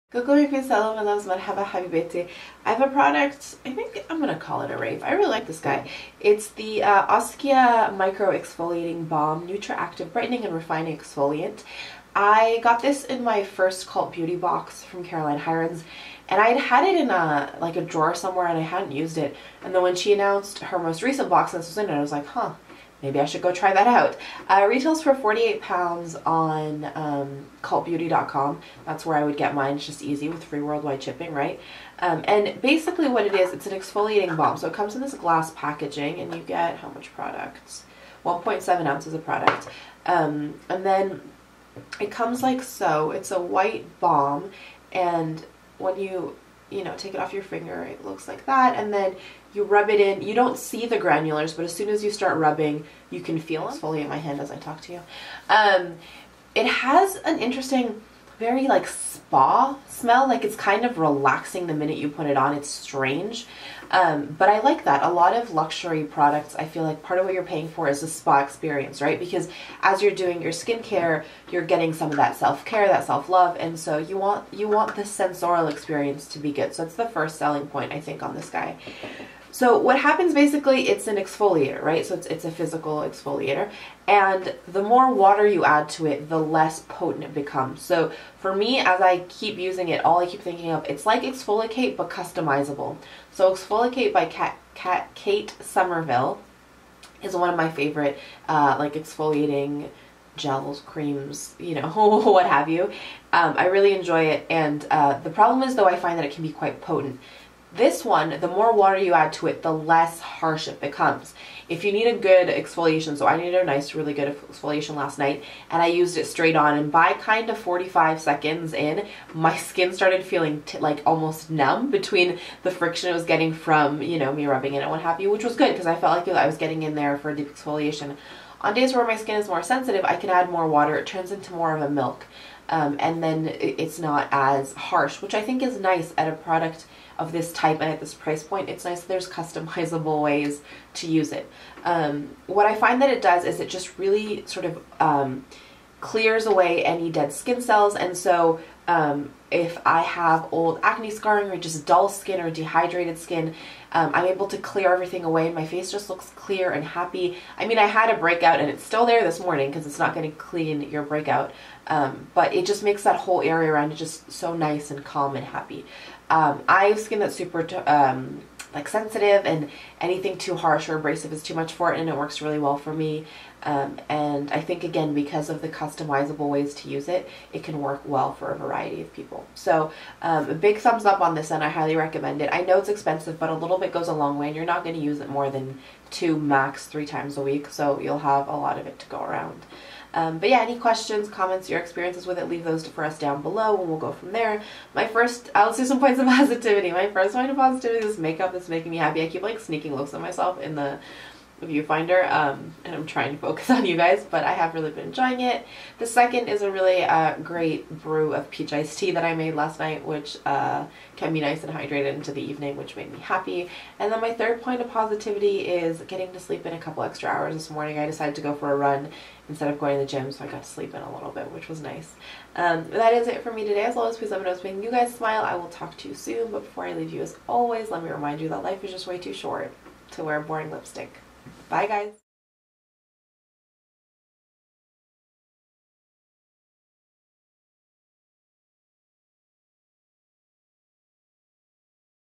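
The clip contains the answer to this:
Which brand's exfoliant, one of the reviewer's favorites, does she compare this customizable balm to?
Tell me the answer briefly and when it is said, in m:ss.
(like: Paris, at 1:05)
Kate Somerville, at 1:35.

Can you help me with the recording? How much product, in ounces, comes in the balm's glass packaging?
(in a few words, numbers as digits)
1.7 ounces.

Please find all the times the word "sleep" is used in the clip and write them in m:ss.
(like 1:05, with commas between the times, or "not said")
3:36, 3:40.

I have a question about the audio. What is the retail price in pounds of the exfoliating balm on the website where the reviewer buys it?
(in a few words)
48 pounds.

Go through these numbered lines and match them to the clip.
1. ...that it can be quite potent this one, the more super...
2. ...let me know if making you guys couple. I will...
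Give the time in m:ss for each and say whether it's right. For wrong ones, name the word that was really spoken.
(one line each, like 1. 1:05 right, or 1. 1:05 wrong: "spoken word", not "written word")
1. 1:46 wrong: "water", not "super"
2. 3:44 wrong: "smile", not "couple".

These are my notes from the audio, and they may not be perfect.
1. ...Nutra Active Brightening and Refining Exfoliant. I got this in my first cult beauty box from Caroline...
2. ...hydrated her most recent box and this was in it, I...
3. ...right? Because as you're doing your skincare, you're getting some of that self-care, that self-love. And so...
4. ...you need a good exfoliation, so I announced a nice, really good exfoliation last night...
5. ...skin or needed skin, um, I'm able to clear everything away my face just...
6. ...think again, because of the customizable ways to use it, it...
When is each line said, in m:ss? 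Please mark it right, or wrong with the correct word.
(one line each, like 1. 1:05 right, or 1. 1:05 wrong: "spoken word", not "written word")
1. 0:09 right
2. 0:20 wrong: "announced", not "hydrated"
3. 1:08 right
4. 1:51 wrong: "needed", not "announced"
5. 2:32 wrong: "dehydrated", not "needed"
6. 2:54 right.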